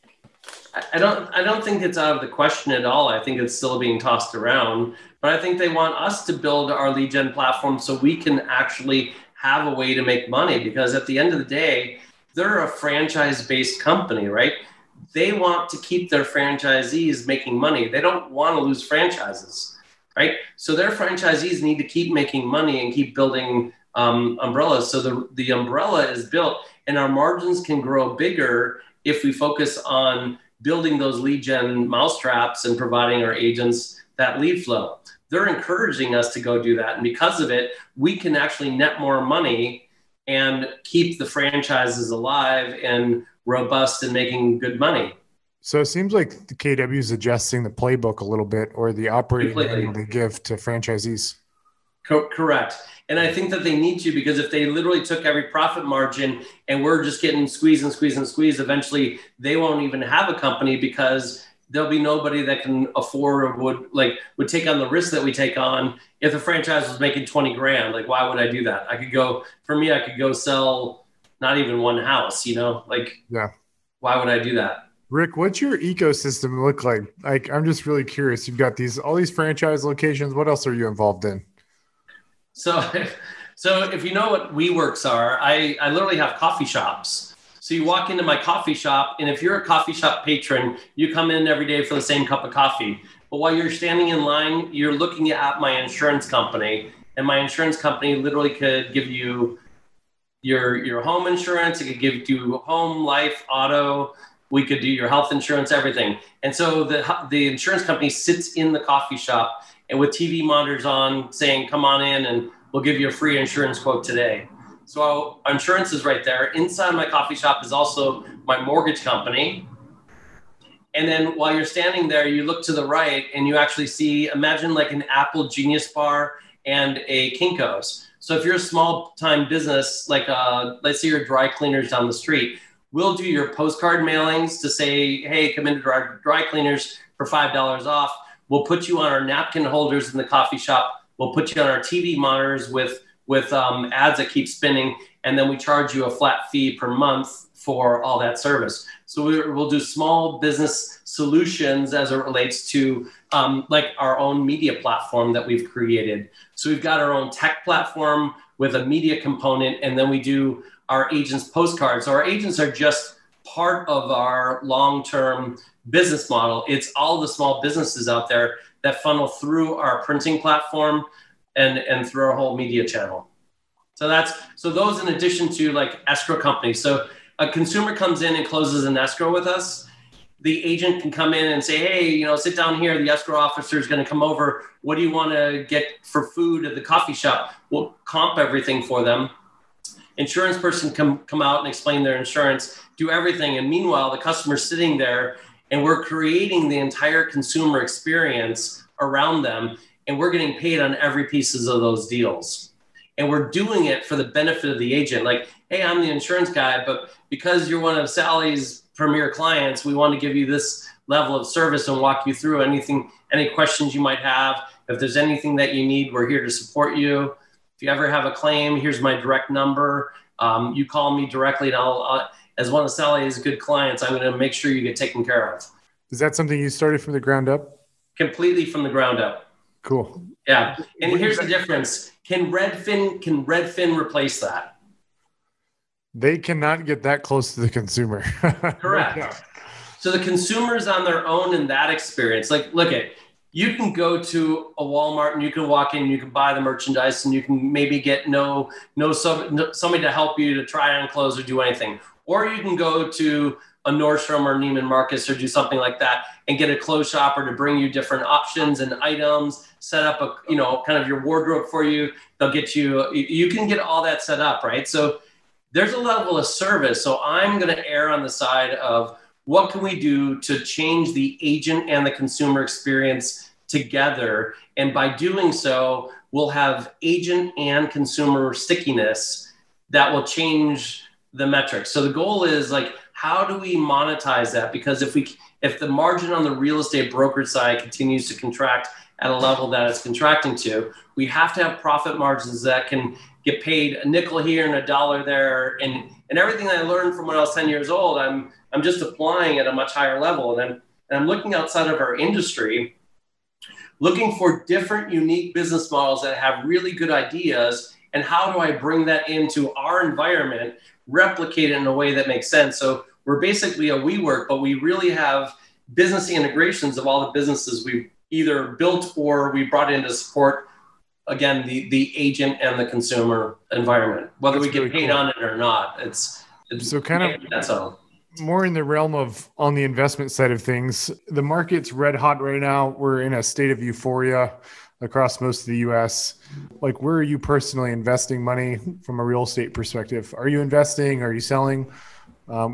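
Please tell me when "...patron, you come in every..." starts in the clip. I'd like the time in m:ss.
1:30.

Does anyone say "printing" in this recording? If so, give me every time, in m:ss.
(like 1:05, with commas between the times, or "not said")
2:50.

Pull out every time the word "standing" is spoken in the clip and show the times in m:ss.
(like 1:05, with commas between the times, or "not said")
1:33, 2:01.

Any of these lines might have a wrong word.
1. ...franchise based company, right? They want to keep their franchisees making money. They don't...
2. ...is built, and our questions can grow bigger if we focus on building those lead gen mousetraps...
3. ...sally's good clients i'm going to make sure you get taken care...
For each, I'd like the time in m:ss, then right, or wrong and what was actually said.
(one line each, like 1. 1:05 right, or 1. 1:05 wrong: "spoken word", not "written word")
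1. 0:12 right
2. 0:26 wrong: "margins", not "questions"
3. 3:42 right.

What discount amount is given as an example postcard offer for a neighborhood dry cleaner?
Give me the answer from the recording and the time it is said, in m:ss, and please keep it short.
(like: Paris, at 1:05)
$5 off, at 2:17.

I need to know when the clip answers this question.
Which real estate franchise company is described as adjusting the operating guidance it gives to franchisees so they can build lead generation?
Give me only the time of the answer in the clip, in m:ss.
0:46.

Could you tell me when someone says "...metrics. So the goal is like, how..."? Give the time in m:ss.
4:41.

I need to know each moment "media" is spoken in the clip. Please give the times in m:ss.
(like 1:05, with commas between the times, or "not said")
2:34, 2:38, 2:52.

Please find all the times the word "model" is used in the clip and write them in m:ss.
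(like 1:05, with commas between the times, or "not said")
2:46, 5:05.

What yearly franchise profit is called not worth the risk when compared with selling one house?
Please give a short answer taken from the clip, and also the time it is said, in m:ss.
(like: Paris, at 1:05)
$20,000, at 1:07.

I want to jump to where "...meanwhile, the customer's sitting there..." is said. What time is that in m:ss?
3:13.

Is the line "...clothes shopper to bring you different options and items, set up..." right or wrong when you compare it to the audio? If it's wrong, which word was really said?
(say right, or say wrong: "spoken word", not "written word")
right.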